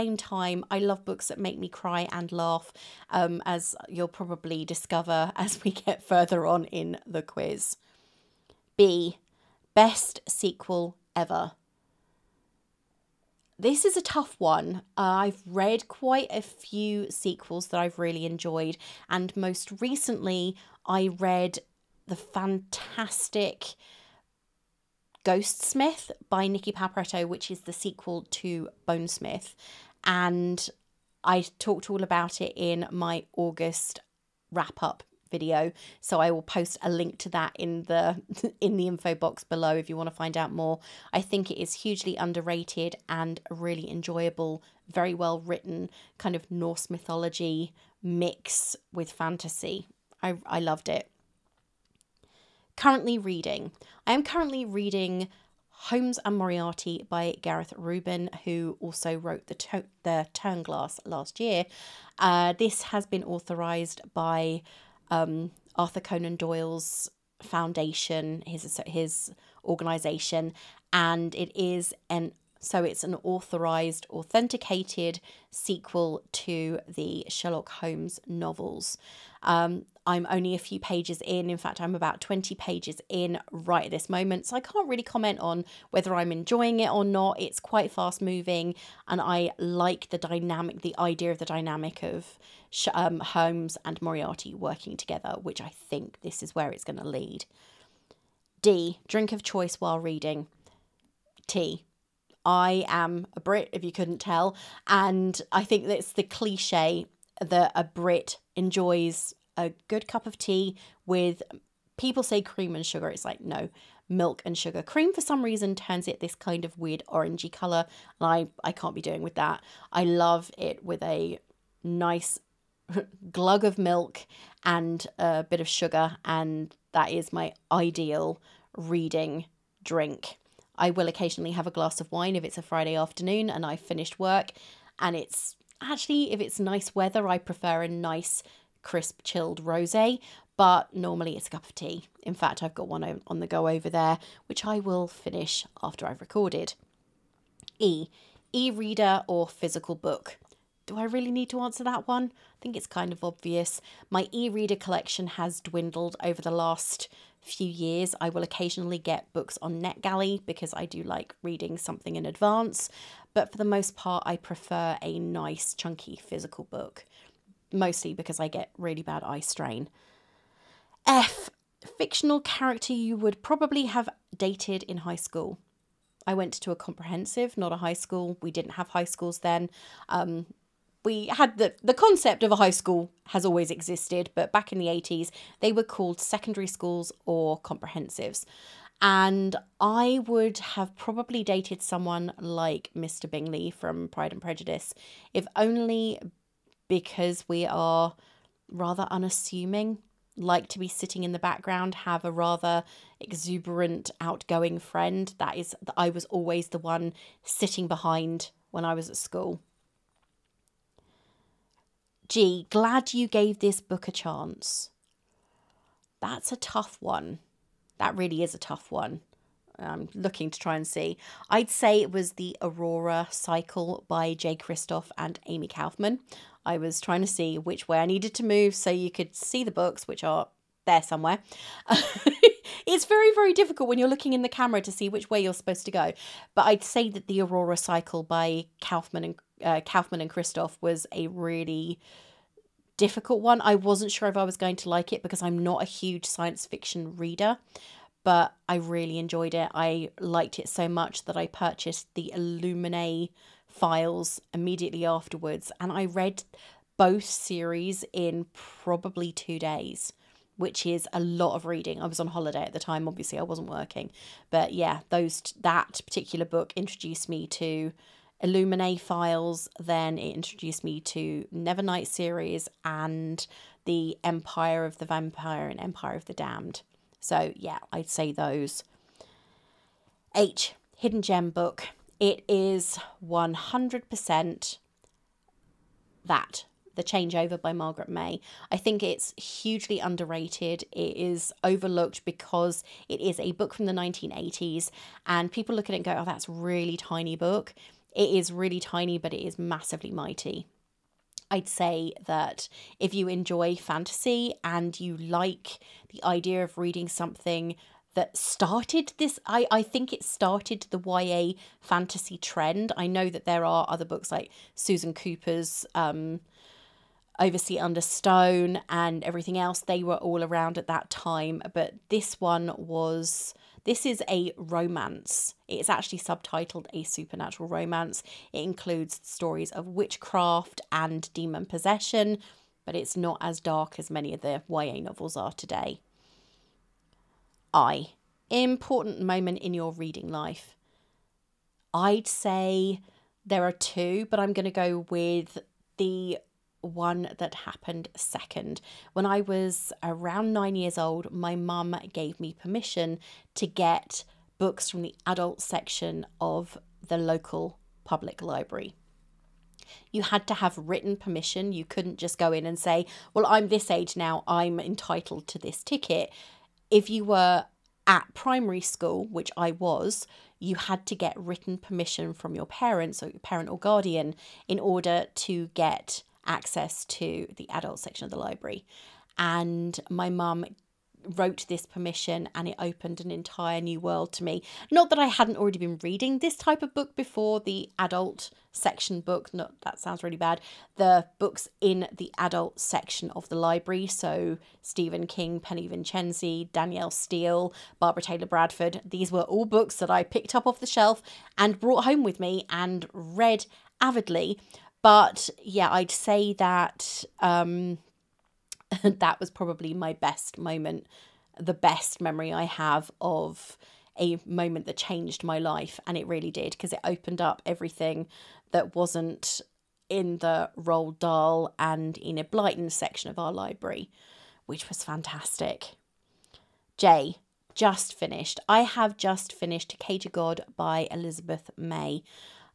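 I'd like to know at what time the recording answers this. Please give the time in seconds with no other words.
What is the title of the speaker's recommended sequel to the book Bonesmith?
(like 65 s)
25 s.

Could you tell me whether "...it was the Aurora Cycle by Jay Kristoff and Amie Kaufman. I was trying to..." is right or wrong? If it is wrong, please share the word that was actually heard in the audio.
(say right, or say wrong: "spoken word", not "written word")
right.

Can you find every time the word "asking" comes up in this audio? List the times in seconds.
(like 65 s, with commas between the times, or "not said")
not said.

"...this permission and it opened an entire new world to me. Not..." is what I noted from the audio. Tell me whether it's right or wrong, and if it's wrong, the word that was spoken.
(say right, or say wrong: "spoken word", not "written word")
right.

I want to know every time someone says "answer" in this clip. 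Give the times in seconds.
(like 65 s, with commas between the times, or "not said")
151 s.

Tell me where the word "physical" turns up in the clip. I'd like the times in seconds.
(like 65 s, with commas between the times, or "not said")
149 s, 166 s.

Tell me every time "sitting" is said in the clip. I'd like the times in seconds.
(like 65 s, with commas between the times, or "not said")
200 s, 207 s.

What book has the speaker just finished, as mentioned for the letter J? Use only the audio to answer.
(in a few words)
Cage a God.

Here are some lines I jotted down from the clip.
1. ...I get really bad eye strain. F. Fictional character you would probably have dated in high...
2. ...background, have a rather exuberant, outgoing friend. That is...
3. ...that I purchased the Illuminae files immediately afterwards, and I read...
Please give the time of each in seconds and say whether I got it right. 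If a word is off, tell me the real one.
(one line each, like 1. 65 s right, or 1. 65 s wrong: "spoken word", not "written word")
1. 168 s right
2. 201 s right
3. 251 s right.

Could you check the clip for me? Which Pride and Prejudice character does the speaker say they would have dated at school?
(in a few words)
Mr. Bingley.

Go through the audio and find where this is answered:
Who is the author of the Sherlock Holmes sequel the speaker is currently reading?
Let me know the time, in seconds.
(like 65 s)
57 s.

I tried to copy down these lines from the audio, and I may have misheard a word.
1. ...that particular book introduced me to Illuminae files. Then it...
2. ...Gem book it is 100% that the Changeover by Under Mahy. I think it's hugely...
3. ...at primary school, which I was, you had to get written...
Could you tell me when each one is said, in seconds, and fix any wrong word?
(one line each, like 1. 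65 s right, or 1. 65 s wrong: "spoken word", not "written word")
1. 265 s right
2. 281 s wrong: "Margaret", not "Under"
3. 368 s right.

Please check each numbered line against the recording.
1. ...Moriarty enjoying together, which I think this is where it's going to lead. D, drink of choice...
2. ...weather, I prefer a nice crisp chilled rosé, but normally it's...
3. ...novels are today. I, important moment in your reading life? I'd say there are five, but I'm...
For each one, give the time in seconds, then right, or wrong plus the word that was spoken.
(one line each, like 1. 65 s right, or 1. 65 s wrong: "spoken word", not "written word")
1. 94 s wrong: "working", not "enjoying"
2. 136 s right
3. 334 s wrong: "two", not "five".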